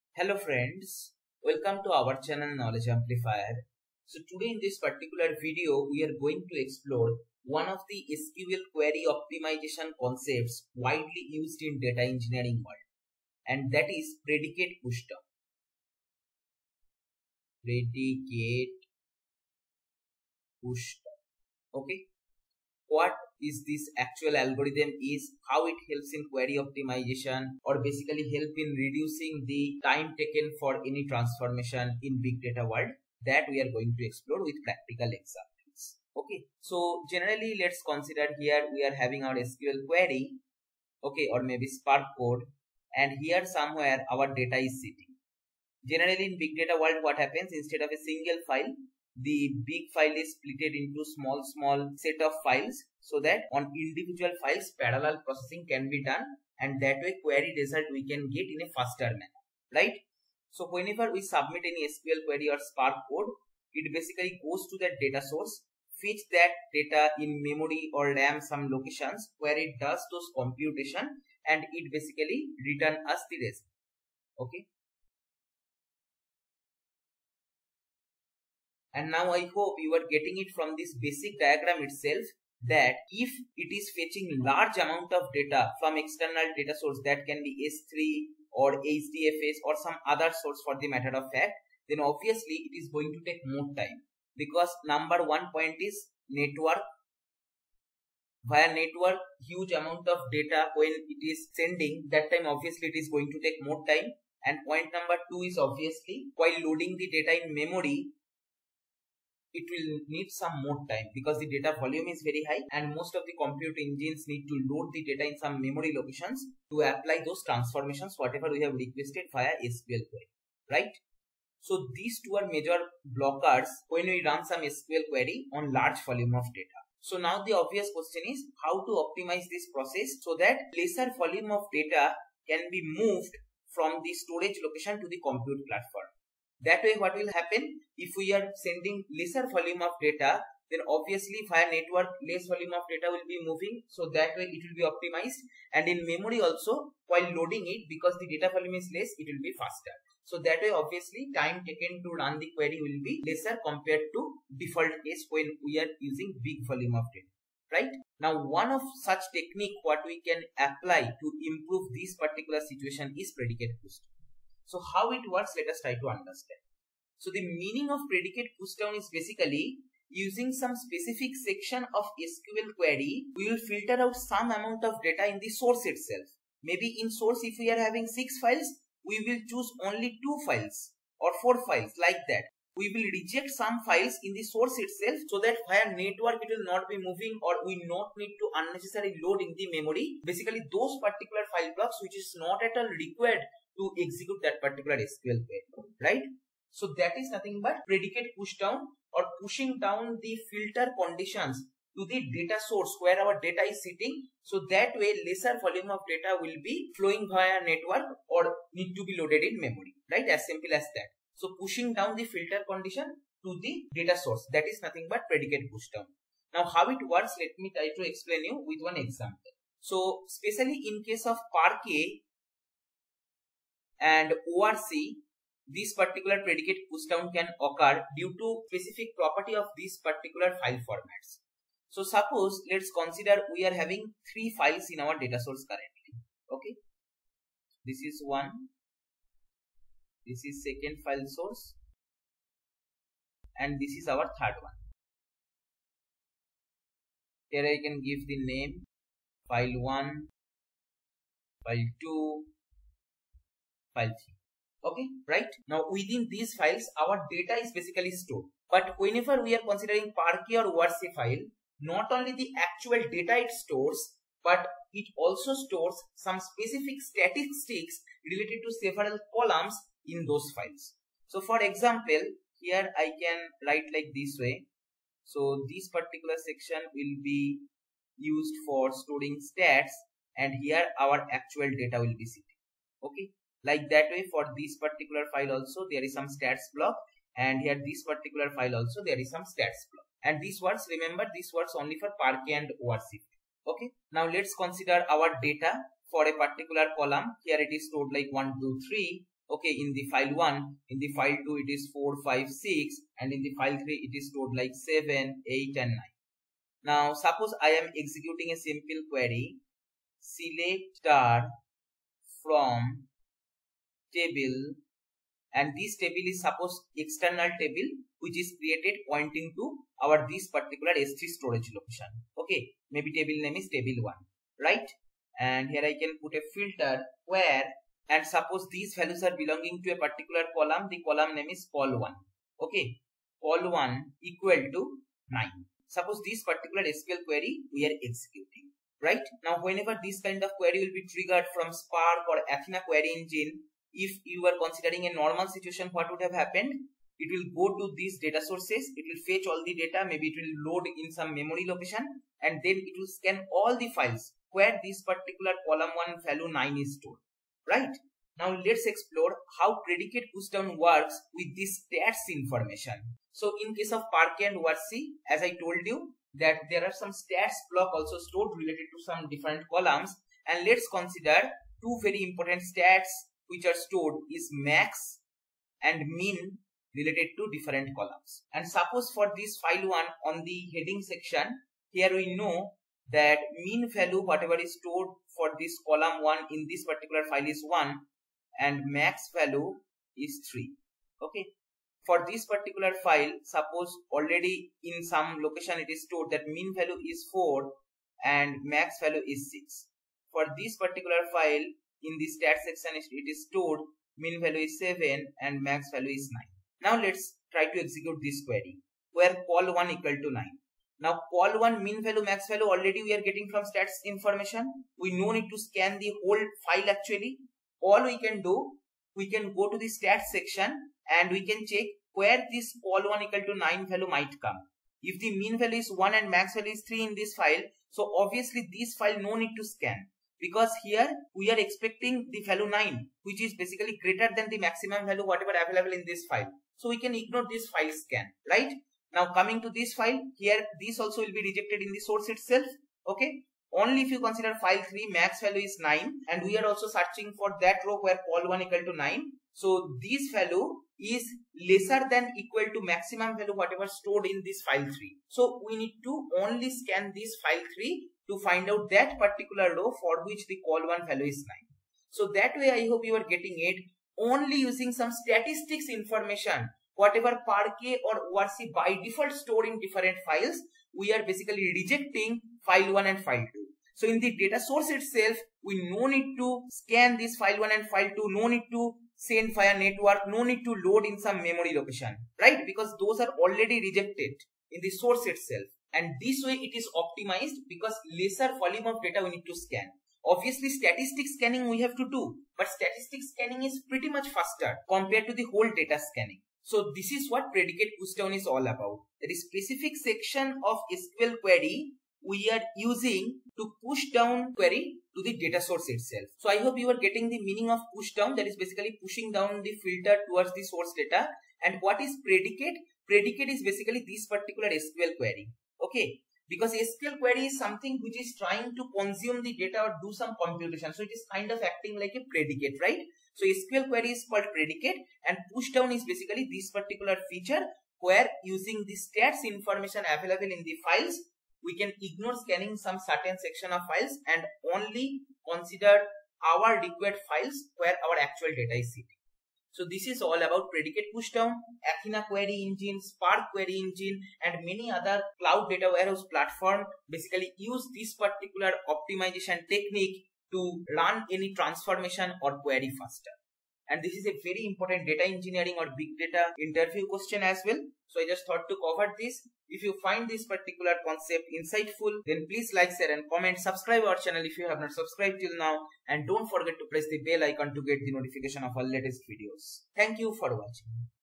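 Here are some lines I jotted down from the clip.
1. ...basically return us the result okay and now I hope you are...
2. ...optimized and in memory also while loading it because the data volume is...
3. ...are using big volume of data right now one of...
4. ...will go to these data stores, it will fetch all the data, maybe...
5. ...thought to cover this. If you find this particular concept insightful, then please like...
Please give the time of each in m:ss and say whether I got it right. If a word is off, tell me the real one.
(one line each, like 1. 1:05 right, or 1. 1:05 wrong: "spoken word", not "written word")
1. 1:11 right
2. 2:24 right
3. 2:35 right
4. 5:47 wrong: "sources", not "stores"
5. 9:18 right.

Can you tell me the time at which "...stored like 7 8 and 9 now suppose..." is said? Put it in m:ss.
5:04.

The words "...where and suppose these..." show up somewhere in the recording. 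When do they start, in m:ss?
5:27.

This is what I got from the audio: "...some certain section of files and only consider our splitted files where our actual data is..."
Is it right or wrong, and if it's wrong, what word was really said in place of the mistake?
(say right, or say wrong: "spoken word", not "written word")
wrong: "required", not "splitted".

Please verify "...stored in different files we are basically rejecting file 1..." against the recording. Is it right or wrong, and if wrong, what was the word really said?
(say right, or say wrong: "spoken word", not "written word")
right.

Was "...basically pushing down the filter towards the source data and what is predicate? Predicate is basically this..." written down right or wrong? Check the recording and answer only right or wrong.
right.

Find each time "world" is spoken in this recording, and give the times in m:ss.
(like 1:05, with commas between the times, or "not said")
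0:12, 0:32, 0:46.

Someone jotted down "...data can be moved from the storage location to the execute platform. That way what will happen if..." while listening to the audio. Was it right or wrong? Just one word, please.
wrong.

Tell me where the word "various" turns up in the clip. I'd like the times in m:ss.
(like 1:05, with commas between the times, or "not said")
not said.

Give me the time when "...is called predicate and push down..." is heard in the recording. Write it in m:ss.
8:44.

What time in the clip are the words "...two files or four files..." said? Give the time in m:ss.
3:00.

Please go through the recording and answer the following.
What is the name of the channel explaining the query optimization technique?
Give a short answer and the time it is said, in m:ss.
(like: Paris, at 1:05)
Knowledge Amplifier, at 0:02.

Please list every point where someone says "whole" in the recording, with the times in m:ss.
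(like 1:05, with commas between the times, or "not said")
6:56, 8:15.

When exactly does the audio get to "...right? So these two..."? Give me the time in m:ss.
2:00.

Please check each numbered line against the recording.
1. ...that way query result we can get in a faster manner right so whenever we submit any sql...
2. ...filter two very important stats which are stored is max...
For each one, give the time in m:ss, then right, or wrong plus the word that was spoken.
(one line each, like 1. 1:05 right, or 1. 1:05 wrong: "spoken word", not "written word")
1. 0:56 right
2. 6:10 wrong: "consider", not "filter".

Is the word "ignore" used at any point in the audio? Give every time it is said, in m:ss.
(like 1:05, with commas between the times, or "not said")
7:17, 8:52.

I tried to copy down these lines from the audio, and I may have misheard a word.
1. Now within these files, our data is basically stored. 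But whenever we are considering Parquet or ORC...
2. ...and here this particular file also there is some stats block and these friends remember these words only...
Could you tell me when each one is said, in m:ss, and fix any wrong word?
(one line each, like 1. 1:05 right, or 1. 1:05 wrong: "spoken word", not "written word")
1. 4:15 right
2. 4:47 wrong: "words", not "friends".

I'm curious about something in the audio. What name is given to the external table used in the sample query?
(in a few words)
table 1.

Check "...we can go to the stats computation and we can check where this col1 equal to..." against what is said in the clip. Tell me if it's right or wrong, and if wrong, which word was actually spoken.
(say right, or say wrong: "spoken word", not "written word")
wrong: "section", not "computation".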